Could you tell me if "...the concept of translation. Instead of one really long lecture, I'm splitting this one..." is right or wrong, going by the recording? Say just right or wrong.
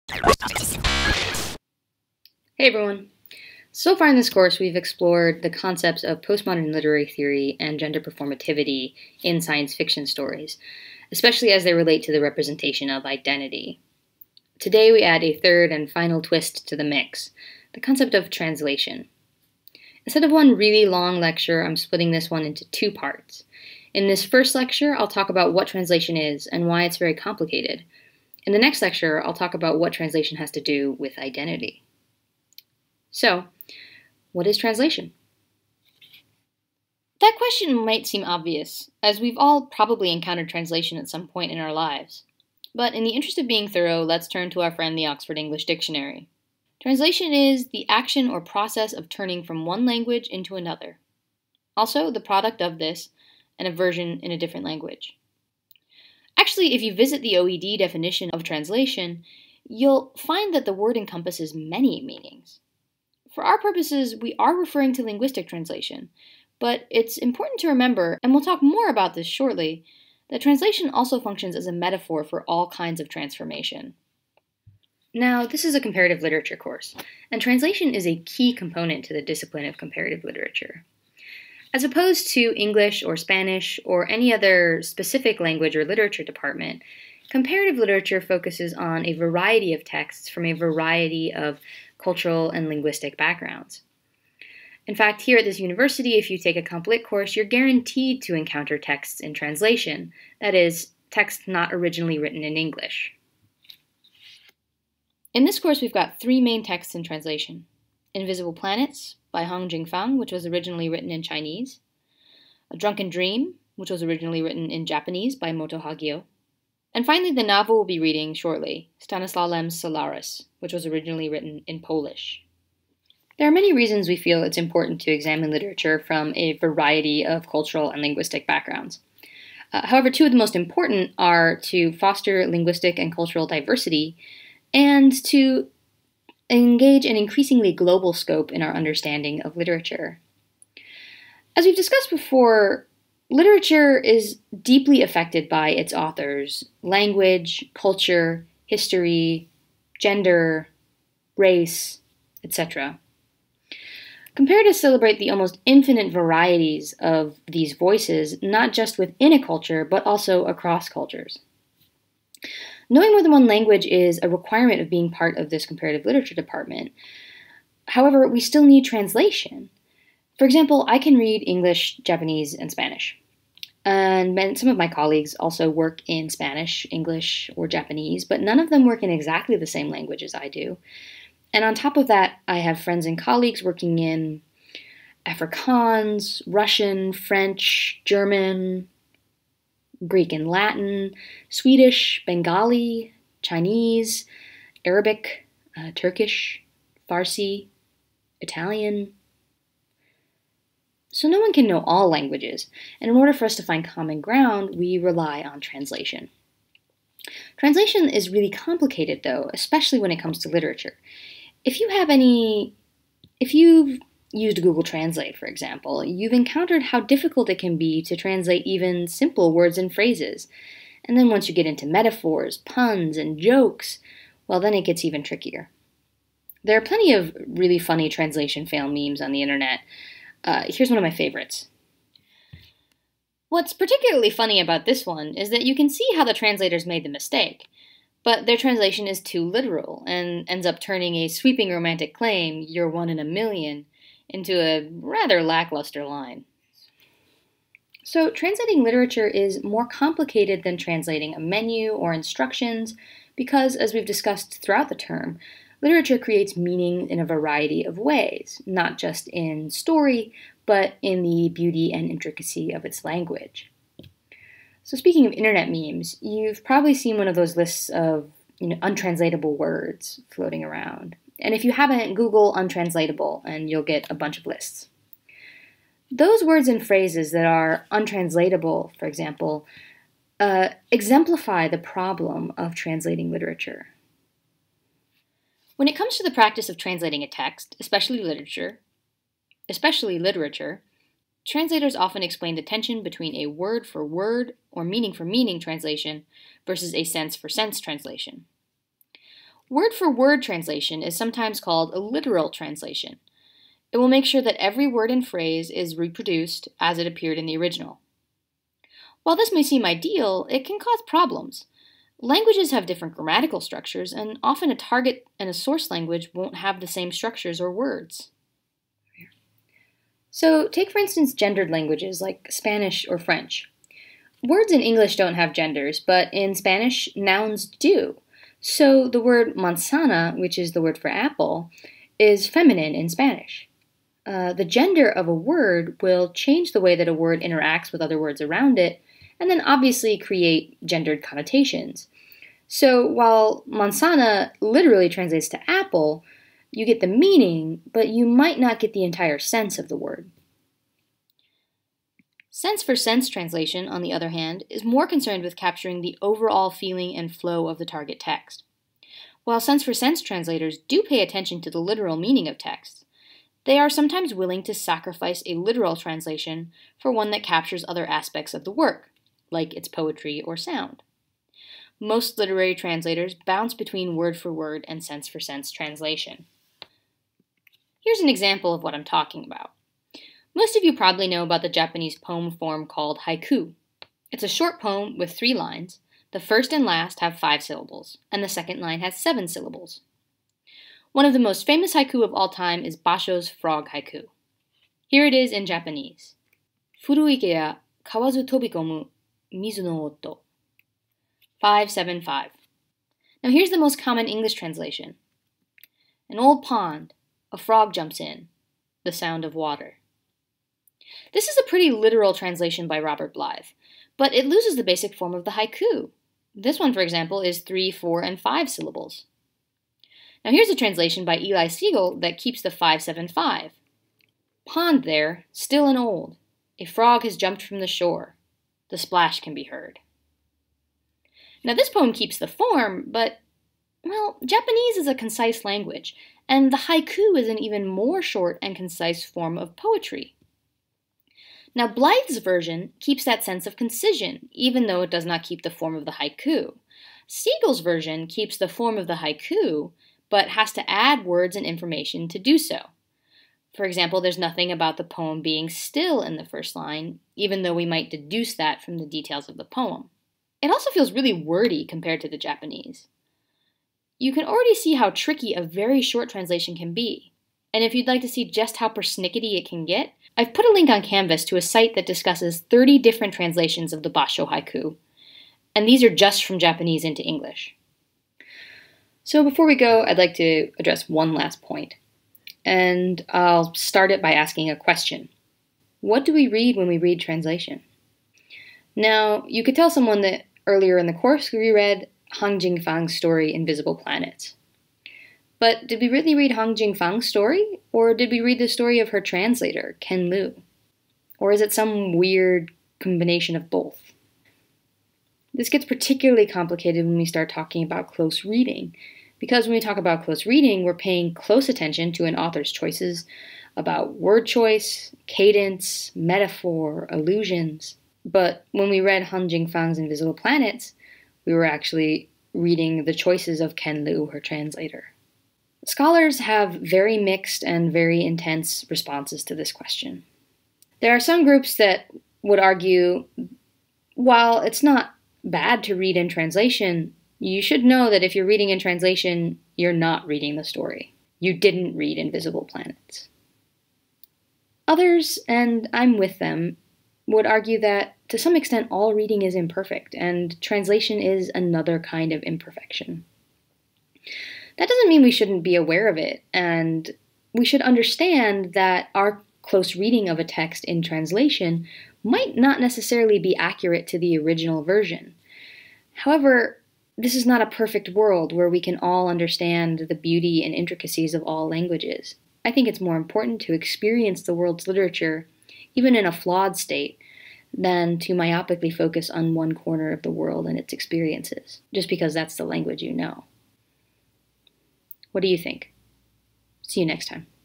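right.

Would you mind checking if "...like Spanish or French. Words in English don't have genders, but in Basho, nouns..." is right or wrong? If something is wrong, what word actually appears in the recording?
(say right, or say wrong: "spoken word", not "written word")
wrong: "Spanish", not "Basho".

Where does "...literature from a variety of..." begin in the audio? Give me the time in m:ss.
2:05.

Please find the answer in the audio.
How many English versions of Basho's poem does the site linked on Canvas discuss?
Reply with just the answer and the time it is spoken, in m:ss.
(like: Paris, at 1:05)
30, at 7:52.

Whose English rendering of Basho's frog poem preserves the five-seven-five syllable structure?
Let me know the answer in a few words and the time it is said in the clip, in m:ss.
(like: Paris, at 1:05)
Eli Siegel, at 7:01.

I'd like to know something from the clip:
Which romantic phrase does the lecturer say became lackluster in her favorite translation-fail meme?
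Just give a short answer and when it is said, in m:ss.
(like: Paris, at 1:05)
you're one in a million, at 4:02.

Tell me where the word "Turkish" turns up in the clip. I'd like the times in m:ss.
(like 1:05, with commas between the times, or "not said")
3:15.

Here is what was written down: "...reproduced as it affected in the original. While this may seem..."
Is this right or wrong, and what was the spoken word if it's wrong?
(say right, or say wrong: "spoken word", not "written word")
wrong: "appeared", not "affected".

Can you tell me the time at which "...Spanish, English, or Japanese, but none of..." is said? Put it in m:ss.
2:56.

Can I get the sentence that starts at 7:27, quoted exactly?
Siegel's version keeps the form of the haiku, but has to add words and information to do so.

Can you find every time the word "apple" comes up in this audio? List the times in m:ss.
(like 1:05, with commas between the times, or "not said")
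5:31, 5:45.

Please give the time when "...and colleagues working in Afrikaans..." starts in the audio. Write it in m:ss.
3:03.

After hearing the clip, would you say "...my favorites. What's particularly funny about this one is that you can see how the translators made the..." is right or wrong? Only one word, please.
right.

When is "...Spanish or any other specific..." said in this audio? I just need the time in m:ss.
1:23.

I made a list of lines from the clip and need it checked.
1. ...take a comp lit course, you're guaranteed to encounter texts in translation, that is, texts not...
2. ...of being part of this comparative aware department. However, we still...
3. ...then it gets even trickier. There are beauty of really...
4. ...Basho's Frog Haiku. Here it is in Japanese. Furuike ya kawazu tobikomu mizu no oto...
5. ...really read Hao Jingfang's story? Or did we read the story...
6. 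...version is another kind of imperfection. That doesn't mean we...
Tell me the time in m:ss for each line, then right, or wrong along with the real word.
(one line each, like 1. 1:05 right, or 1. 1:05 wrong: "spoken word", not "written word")
1. 1:36 right
2. 2:44 wrong: "literature", not "aware"
3. 3:44 wrong: "plenty", not "beauty"
4. 6:32 right
5. 8:16 right
6. 9:10 wrong: "translation", not "version".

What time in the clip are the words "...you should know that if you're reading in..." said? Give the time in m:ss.
8:57.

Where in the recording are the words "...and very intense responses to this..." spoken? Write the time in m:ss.
8:47.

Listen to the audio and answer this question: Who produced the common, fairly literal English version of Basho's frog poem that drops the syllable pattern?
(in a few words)
Robert Blythe.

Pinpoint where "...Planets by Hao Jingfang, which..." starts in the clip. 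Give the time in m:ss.
1:48.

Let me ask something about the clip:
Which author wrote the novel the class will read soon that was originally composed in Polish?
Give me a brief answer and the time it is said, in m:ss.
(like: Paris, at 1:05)
Stanislaw Lem, at 1:58.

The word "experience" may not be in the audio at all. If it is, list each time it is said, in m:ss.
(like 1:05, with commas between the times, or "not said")
9:33, 9:40.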